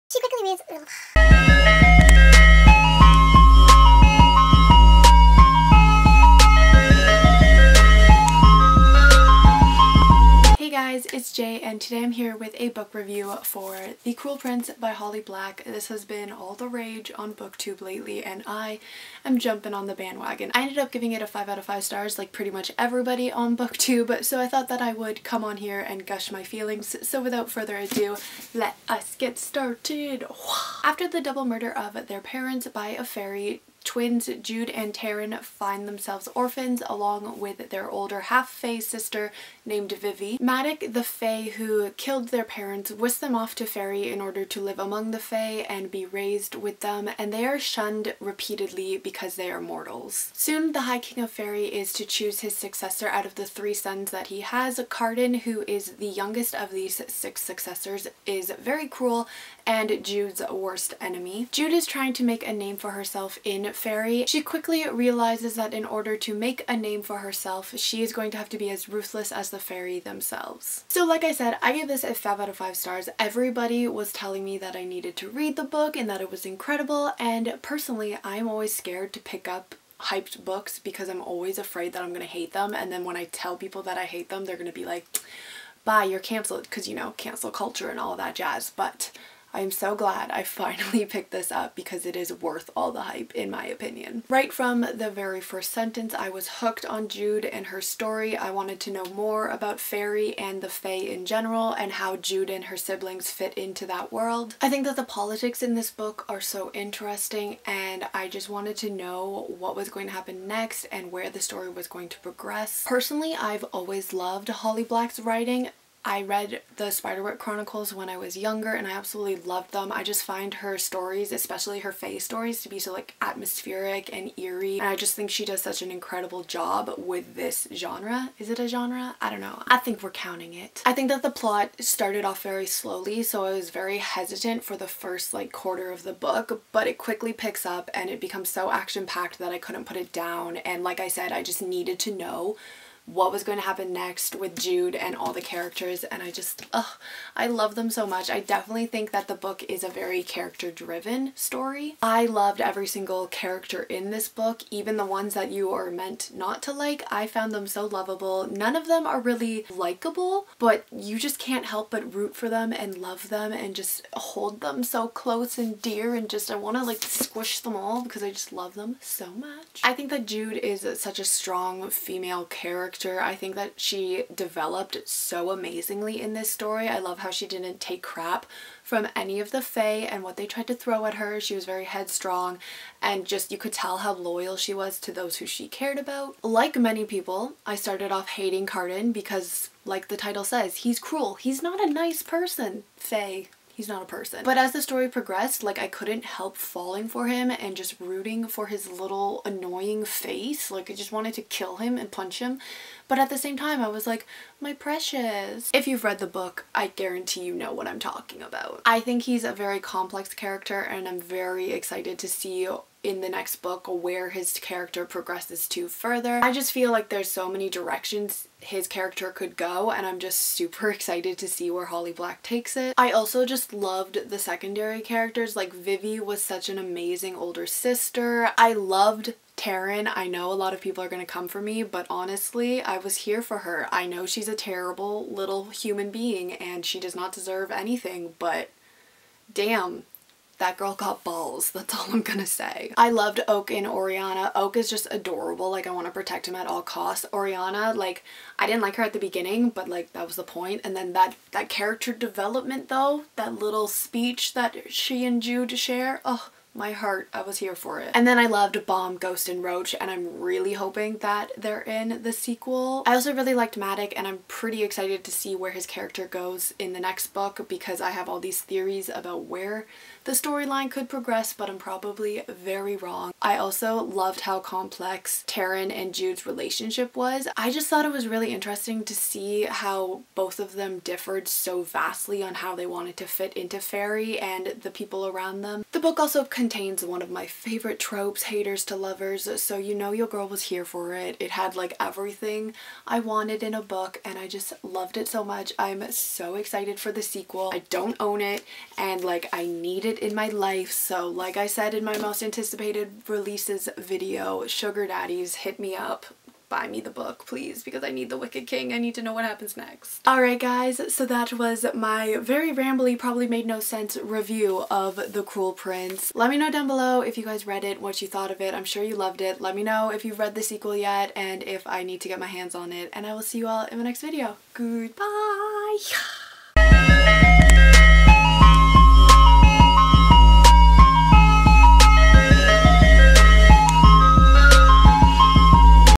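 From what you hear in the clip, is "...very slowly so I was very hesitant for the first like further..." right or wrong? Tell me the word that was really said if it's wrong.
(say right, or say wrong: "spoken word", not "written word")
wrong: "quarter", not "further".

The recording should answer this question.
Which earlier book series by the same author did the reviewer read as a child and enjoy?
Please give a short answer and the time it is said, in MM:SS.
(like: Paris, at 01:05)
The Spiderwick Chronicles, at 01:56.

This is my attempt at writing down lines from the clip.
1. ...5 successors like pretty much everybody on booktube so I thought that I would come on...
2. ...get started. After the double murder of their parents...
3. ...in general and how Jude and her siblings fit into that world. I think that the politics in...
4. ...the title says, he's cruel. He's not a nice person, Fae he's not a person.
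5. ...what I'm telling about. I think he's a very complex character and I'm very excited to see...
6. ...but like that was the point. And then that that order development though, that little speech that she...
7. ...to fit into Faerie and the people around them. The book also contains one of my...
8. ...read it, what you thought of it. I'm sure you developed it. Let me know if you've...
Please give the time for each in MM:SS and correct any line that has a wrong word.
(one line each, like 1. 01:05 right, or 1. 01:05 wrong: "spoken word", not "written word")
1. 00:21 wrong: "stars", not "successors"
2. 00:29 right
3. 01:40 right
4. 03:10 right
5. 03:27 wrong: "talking", not "telling"
6. 04:09 wrong: "character", not "order"
7. 04:43 right
8. 05:17 wrong: "loved", not "developed".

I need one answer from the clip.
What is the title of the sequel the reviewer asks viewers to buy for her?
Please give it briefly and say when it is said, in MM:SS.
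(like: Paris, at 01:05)
The Wicked King, at 05:08.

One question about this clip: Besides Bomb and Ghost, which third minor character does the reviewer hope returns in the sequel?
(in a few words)
Roach.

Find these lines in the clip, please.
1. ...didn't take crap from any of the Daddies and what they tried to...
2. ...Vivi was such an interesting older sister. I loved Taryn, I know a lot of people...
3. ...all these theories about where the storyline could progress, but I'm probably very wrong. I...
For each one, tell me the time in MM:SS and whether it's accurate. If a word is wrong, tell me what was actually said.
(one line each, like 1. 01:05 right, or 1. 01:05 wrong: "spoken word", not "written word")
1. 02:57 wrong: "Fae", not "Daddies"
2. 03:45 wrong: "amazing", not "interesting"
3. 04:28 right.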